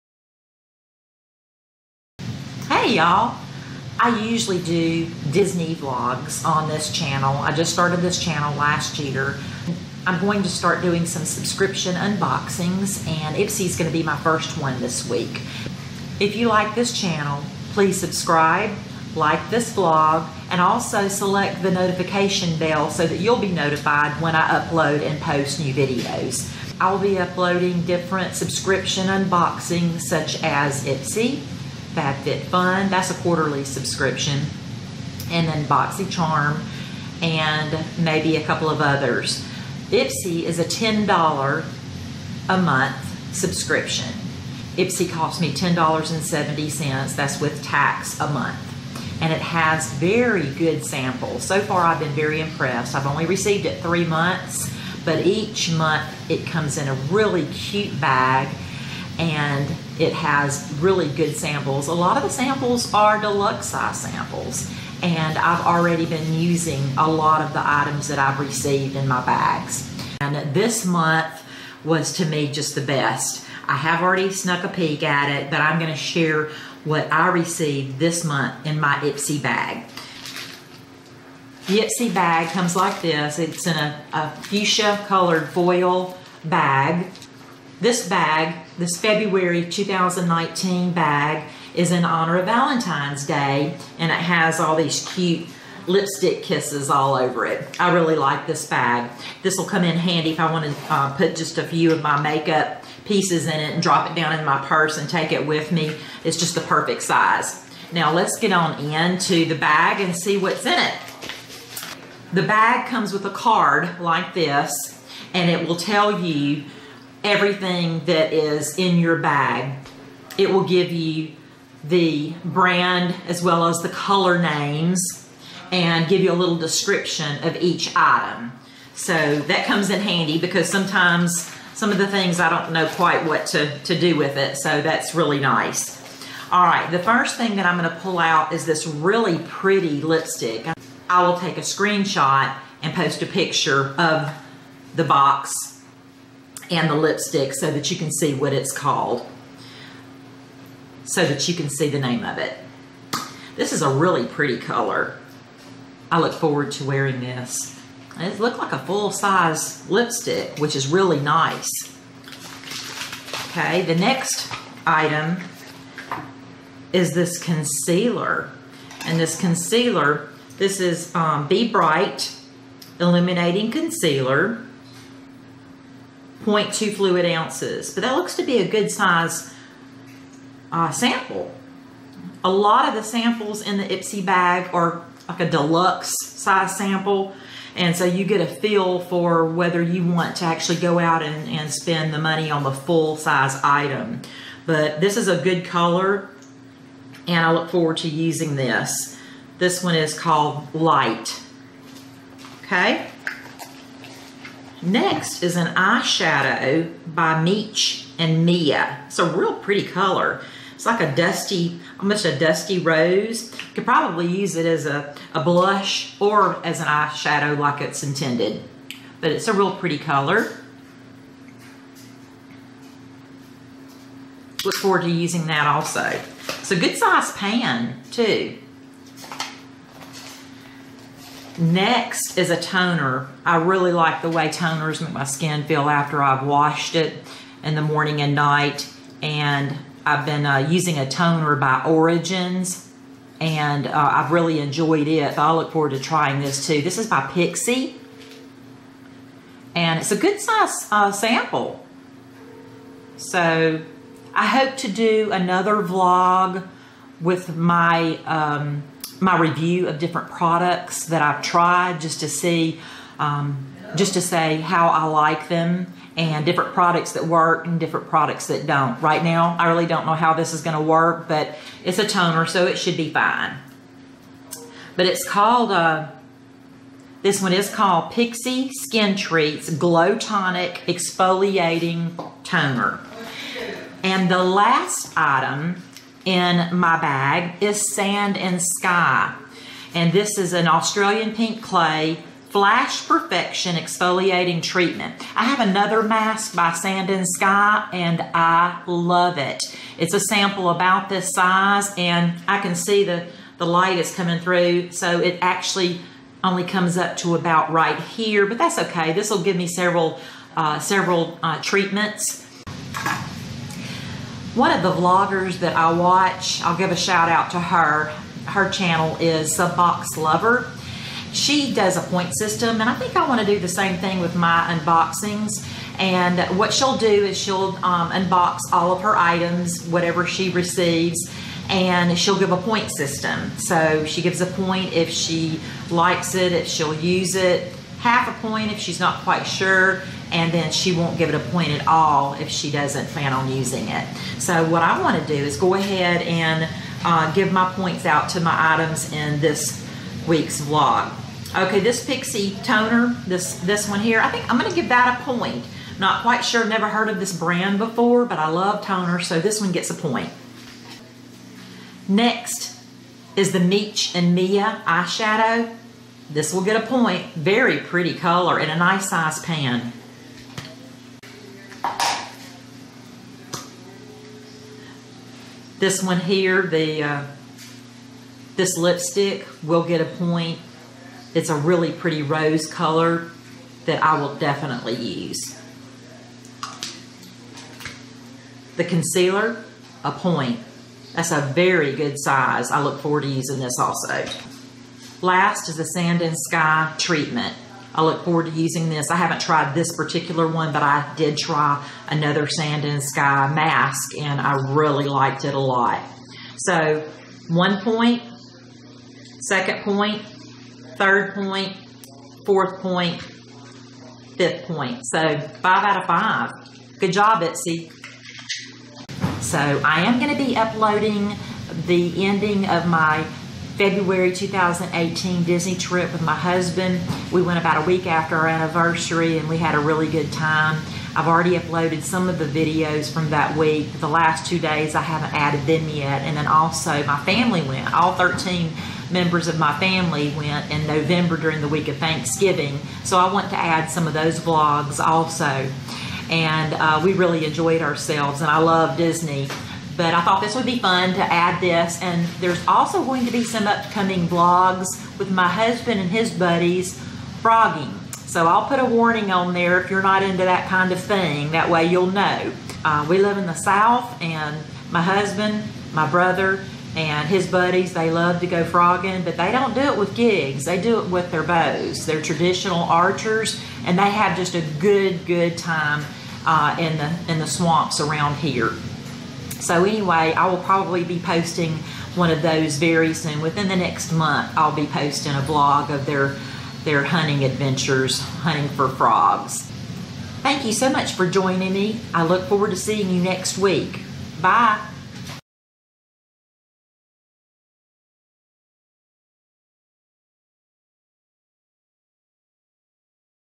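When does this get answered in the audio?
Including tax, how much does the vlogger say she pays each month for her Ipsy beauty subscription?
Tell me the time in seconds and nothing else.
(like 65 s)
45 s.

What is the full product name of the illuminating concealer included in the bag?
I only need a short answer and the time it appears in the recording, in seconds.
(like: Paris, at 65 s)
Be Bright Illuminating Concealer, at 171 s.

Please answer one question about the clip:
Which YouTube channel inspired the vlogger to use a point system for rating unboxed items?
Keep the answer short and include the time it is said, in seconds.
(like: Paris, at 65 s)
Subbox Lover, at 319 s.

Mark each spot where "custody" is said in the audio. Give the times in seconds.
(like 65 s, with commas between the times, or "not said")
not said.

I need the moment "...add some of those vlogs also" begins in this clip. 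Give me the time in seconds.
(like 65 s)
443 s.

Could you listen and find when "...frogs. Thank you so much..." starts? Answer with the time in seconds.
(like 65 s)
488 s.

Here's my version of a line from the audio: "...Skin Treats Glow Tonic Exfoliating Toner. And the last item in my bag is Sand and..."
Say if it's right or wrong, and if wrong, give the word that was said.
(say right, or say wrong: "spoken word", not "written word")
right.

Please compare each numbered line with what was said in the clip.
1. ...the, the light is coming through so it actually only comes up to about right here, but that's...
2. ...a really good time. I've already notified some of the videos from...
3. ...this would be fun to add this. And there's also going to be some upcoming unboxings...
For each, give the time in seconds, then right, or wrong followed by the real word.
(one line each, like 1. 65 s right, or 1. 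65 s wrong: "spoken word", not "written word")
1. 303 s right
2. 429 s wrong: "uploaded", not "notified"
3. 450 s wrong: "vlogs", not "unboxings".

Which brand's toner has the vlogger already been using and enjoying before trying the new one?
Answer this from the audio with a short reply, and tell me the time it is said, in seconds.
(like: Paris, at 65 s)
Origins, at 241 s.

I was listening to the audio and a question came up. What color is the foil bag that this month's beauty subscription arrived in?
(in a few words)
fuchsia.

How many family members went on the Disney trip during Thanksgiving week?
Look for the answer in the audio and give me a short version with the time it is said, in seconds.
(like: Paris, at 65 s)
13, at 438 s.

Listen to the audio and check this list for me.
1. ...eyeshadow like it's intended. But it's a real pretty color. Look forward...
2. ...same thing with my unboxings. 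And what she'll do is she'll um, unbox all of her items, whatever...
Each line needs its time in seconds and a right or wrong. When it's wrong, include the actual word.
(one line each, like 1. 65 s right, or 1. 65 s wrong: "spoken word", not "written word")
1. 216 s right
2. 323 s right.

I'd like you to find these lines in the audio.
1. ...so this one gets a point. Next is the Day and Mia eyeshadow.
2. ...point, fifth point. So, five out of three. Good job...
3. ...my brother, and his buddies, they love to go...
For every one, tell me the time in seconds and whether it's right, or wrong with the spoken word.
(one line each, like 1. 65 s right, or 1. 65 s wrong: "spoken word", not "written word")
1. 359 s wrong: "Meech", not "Day"
2. 412 s wrong: "five", not "three"
3. 465 s right.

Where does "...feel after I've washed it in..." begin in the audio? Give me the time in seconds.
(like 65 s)
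235 s.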